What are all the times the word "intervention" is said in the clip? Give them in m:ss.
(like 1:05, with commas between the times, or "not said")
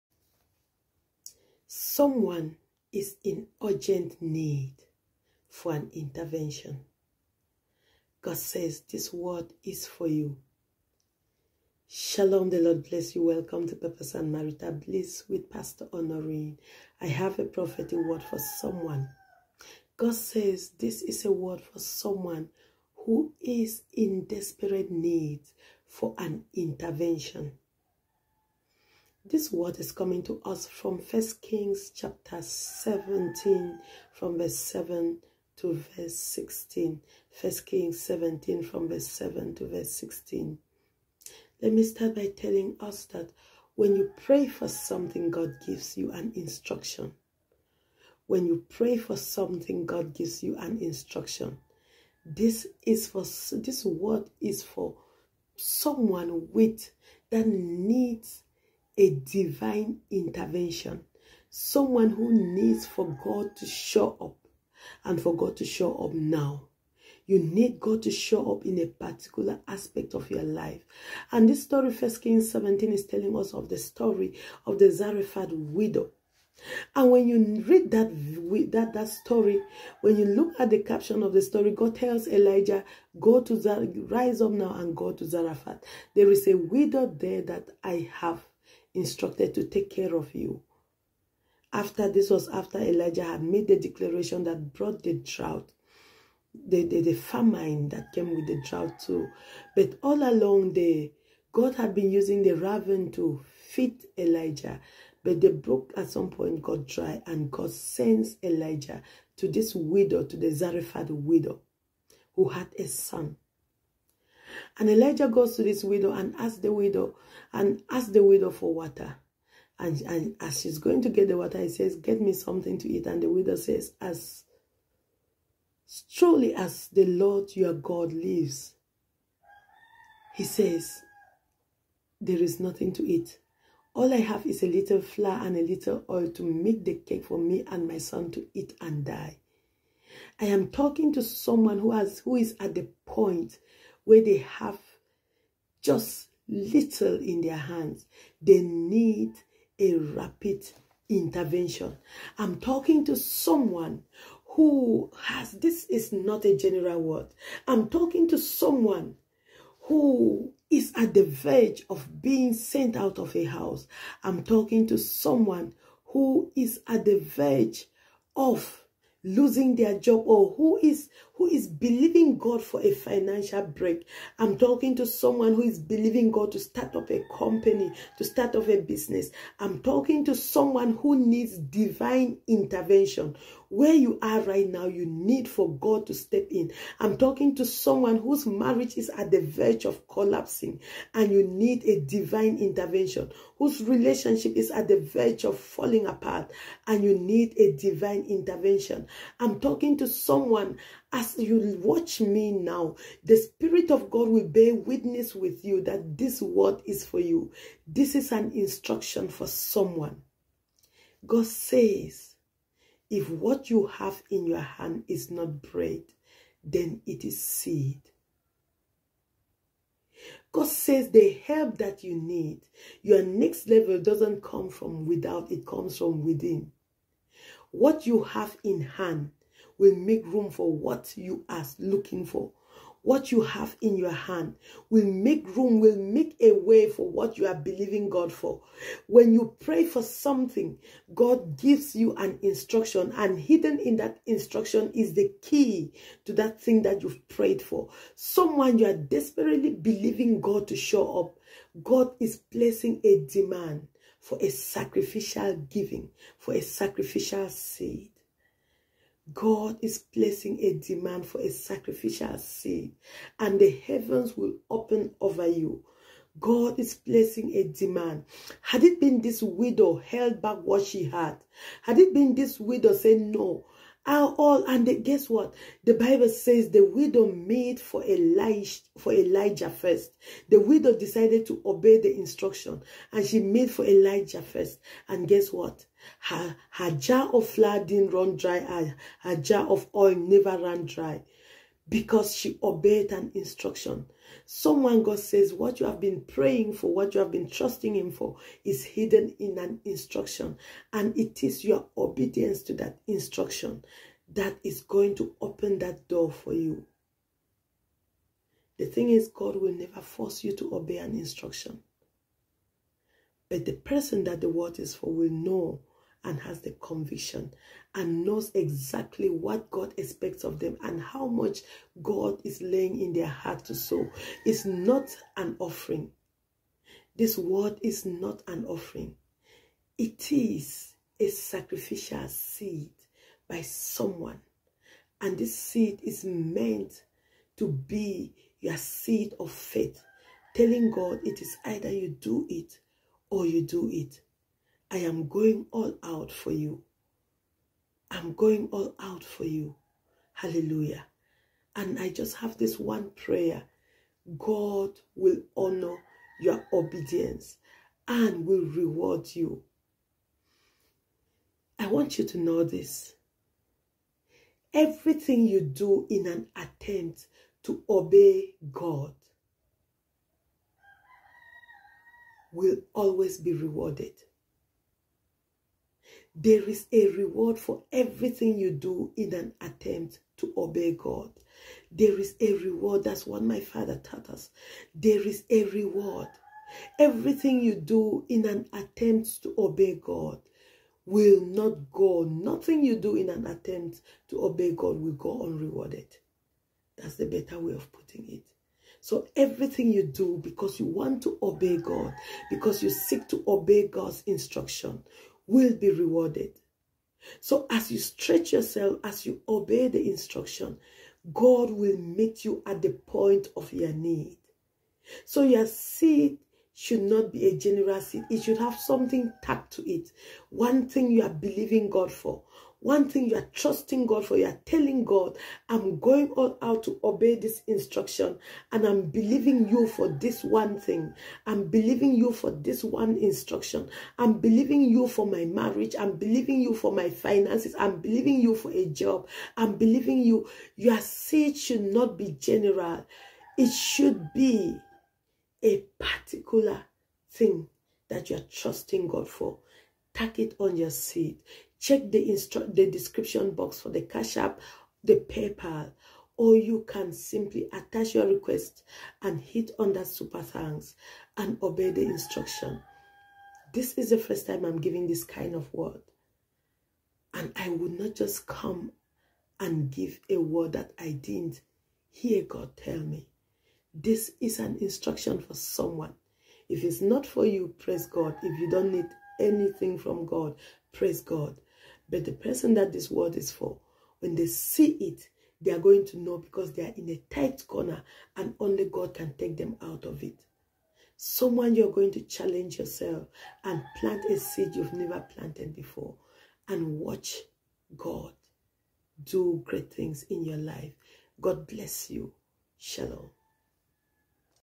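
0:05, 0:26, 1:00, 2:31, 3:02, 3:12, 3:18.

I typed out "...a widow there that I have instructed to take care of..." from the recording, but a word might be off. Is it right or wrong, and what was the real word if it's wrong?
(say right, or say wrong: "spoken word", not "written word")
right.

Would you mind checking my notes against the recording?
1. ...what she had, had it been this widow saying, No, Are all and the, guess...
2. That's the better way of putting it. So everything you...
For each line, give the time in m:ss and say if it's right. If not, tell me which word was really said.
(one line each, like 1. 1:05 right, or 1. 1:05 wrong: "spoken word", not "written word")
1. 4:30 right
2. 6:36 right.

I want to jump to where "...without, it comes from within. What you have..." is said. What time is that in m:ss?
3:45.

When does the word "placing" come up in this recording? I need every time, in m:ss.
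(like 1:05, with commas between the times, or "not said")
4:12, 4:19, 4:26.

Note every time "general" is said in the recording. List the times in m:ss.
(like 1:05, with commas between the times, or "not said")
2:36, 6:57, 7:22.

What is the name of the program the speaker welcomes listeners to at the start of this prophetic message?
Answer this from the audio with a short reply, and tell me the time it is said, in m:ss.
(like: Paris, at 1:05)
Purpose and Marital Bliss, at 0:13.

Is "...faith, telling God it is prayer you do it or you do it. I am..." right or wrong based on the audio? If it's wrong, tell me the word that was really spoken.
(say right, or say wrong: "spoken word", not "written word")
wrong: "either", not "prayer".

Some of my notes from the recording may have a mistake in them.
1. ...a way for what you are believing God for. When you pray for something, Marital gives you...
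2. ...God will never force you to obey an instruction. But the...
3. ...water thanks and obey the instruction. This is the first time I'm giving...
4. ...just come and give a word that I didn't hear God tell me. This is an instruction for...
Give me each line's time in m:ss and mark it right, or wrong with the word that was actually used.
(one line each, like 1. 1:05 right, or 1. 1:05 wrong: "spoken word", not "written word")
1. 3:56 wrong: "God", not "Marital"
2. 5:09 right
3. 7:40 wrong: "super", not "water"
4. 7:48 right.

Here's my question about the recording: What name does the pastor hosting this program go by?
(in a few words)
Pastor Honorine.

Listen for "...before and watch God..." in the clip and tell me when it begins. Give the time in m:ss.
8:15.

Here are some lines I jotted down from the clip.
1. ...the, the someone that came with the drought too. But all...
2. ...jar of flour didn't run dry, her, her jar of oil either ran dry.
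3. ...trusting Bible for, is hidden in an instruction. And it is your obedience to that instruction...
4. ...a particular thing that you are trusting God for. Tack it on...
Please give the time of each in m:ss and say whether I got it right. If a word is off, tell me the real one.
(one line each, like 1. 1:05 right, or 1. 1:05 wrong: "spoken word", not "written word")
1. 1:36 wrong: "famine", not "someone"
2. 4:46 wrong: "never", not "either"
3. 4:57 wrong: "Him", not "Bible"
4. 7:25 right.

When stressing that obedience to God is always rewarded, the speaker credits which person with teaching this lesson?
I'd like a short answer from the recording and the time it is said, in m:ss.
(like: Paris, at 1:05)
my father, at 6:23.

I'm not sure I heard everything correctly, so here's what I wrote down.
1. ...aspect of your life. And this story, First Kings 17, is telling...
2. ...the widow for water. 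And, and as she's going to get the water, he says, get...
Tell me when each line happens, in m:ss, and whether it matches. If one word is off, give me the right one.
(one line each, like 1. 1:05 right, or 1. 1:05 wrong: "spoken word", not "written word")
1. 1:09 right
2. 1:58 right.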